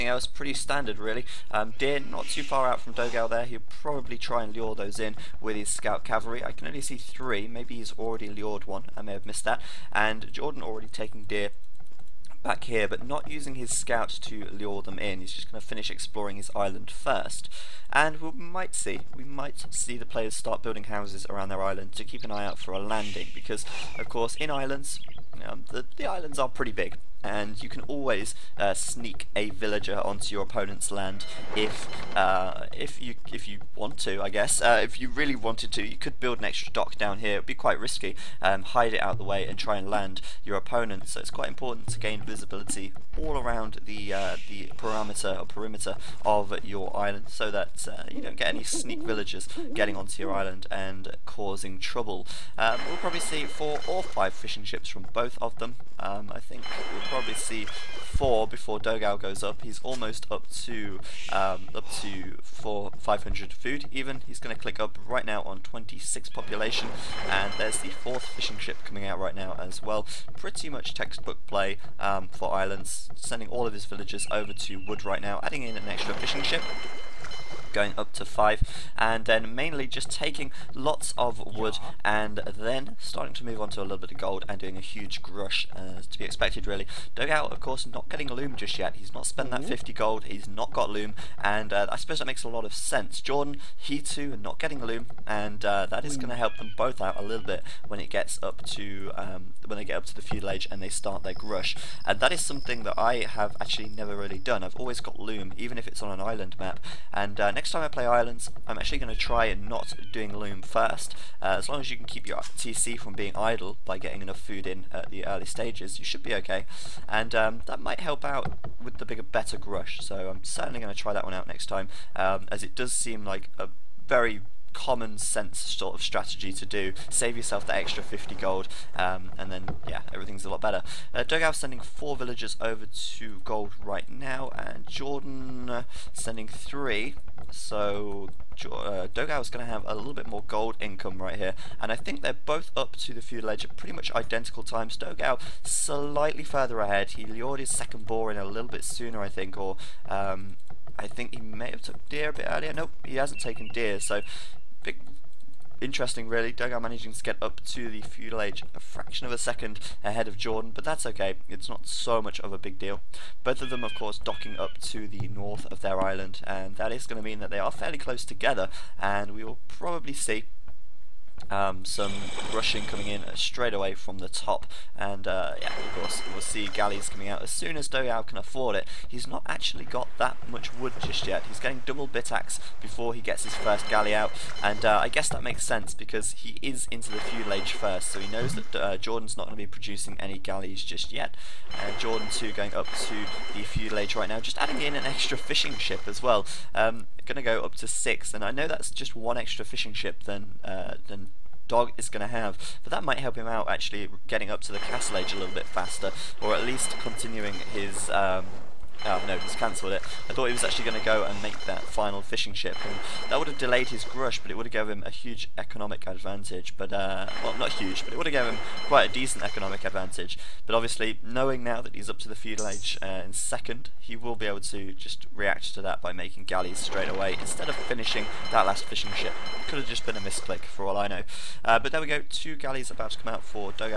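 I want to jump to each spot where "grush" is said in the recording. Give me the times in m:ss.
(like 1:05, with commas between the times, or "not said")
1:25, 1:41, 1:59, 3:34.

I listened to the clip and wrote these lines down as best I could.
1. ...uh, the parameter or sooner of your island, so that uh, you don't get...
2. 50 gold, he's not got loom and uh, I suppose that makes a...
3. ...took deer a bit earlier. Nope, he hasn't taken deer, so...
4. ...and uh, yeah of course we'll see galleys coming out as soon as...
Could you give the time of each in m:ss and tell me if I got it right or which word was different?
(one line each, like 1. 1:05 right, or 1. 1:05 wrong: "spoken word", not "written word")
1. 0:44 wrong: "perimeter", not "sooner"
2. 1:29 right
3. 2:31 right
4. 2:54 right.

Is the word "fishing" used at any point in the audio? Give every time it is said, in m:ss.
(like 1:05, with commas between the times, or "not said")
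0:54, 1:08, 1:16, 3:15, 3:19, 3:32, 3:48.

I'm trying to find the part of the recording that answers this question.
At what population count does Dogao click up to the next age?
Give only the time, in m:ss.
1:05.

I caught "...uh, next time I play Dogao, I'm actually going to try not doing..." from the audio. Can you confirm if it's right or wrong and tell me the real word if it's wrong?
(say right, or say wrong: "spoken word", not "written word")
wrong: "Islands", not "Dogao".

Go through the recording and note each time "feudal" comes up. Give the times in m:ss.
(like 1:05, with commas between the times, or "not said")
1:40, 2:23, 2:38, 3:07, 3:13, 3:42.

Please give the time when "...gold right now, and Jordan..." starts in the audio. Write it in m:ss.
2:13.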